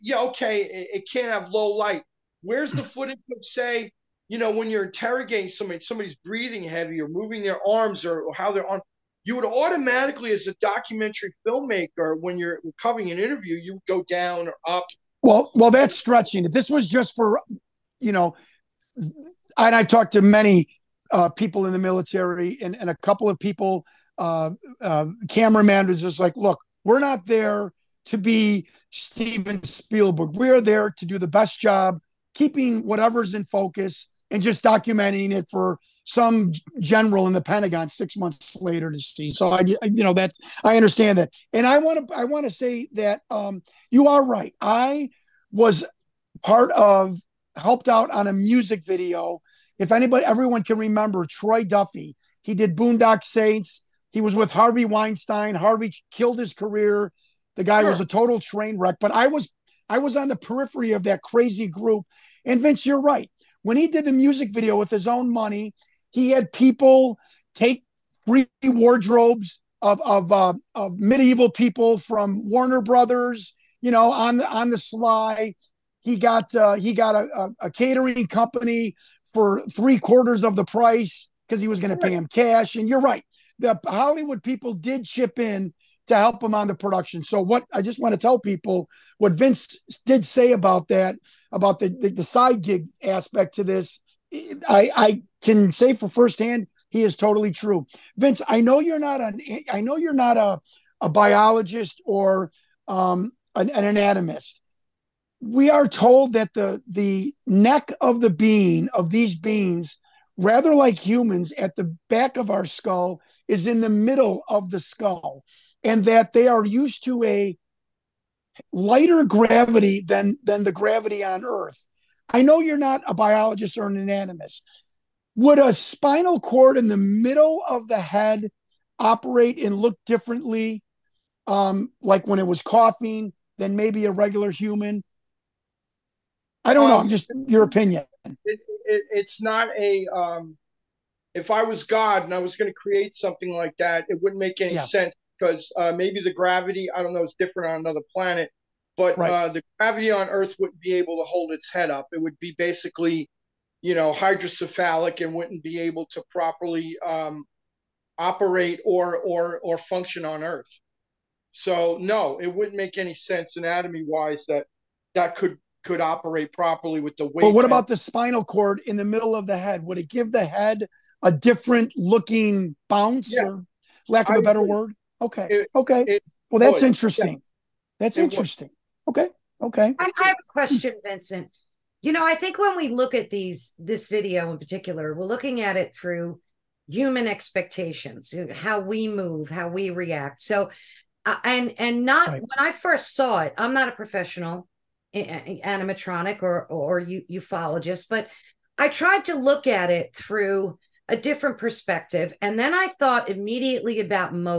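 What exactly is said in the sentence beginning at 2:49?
Would it give the head a different looking bounce yeah.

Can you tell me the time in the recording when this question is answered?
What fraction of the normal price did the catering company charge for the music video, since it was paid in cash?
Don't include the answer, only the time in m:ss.
1:19.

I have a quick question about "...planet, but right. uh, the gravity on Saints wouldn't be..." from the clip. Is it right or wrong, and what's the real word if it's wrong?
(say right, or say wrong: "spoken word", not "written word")
wrong: "Earth", not "Saints".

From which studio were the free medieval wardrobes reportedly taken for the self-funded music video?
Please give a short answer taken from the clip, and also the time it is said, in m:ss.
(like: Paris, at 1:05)
Warner Brothers, at 1:12.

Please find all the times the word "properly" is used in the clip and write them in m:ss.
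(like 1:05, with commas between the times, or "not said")
2:36, 2:46.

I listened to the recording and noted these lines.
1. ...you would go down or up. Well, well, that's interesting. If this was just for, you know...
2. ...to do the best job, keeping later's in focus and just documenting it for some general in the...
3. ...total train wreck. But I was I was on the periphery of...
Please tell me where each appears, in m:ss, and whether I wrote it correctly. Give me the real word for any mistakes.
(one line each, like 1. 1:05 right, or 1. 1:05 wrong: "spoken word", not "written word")
1. 0:13 wrong: "stretching", not "interesting"
2. 0:30 wrong: "whatever", not "later"
3. 0:58 right.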